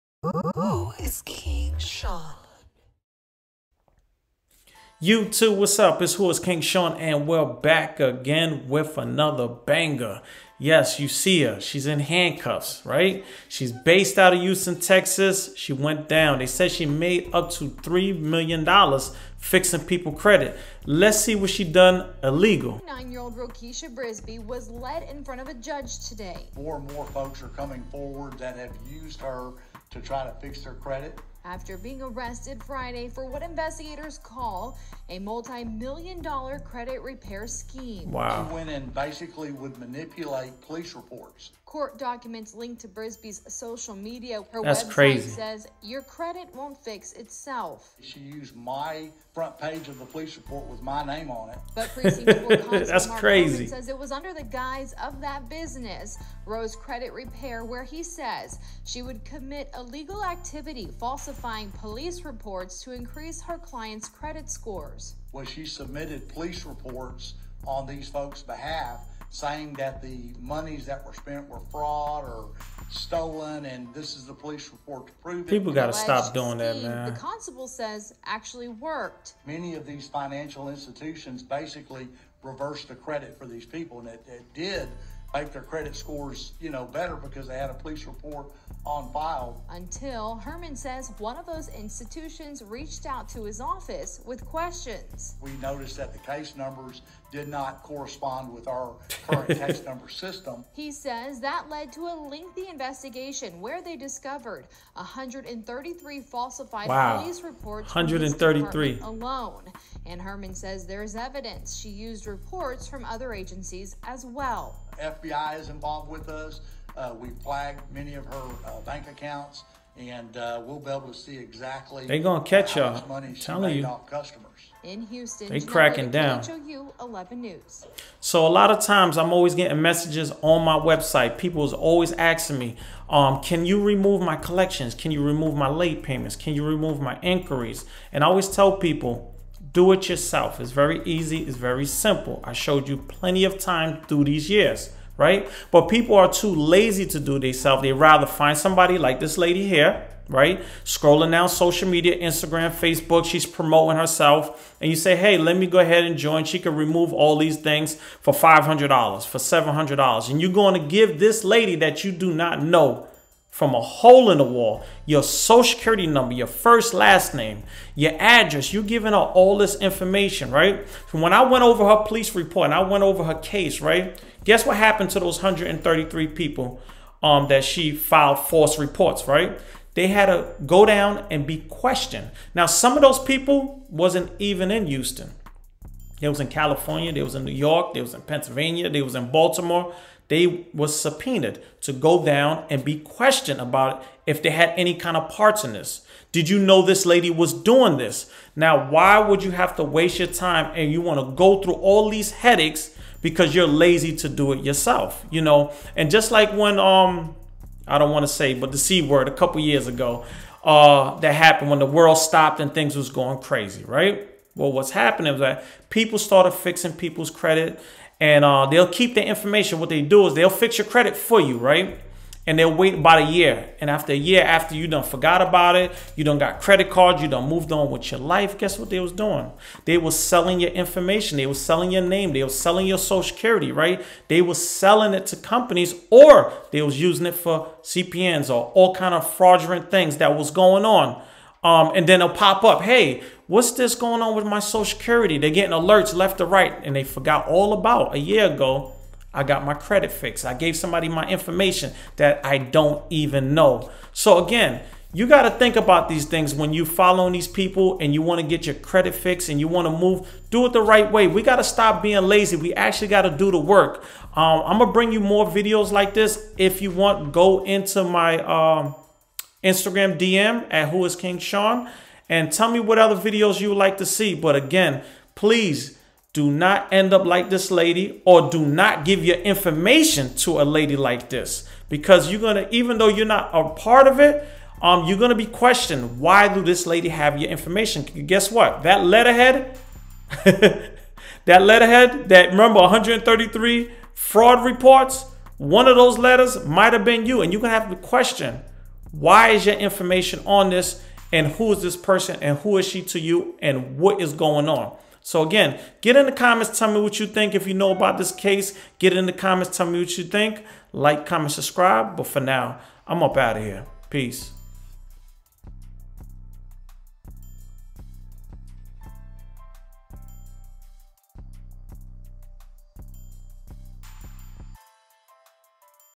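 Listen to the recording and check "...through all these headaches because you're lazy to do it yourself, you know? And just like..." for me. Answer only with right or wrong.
right.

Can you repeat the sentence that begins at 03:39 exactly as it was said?
What they do is they'll fix your credit for you, right?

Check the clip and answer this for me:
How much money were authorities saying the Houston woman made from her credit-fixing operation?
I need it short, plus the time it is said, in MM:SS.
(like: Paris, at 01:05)
$3 million, at 00:17.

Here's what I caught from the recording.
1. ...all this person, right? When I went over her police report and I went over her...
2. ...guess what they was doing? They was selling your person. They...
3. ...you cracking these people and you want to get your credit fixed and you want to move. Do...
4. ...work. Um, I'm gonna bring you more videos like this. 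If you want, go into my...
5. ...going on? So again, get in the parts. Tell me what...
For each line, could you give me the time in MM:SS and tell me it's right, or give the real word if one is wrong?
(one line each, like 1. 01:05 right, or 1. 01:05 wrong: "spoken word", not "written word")
1. 02:49 wrong: "information", not "person"
2. 03:48 wrong: "information", not "person"
3. 04:16 wrong: "following", not "cracking"
4. 04:23 right
5. 05:04 wrong: "comments", not "parts".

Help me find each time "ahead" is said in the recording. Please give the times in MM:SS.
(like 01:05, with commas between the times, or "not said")
02:35.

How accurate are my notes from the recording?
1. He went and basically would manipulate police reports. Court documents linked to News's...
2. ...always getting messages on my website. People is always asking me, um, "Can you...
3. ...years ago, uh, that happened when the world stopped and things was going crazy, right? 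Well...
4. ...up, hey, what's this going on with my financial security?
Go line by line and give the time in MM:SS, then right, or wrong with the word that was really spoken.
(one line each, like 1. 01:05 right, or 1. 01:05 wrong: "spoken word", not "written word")
1. 00:38 wrong: "Brisby", not "News"
2. 02:09 right
3. 03:29 right
4. 04:02 wrong: "social", not "financial".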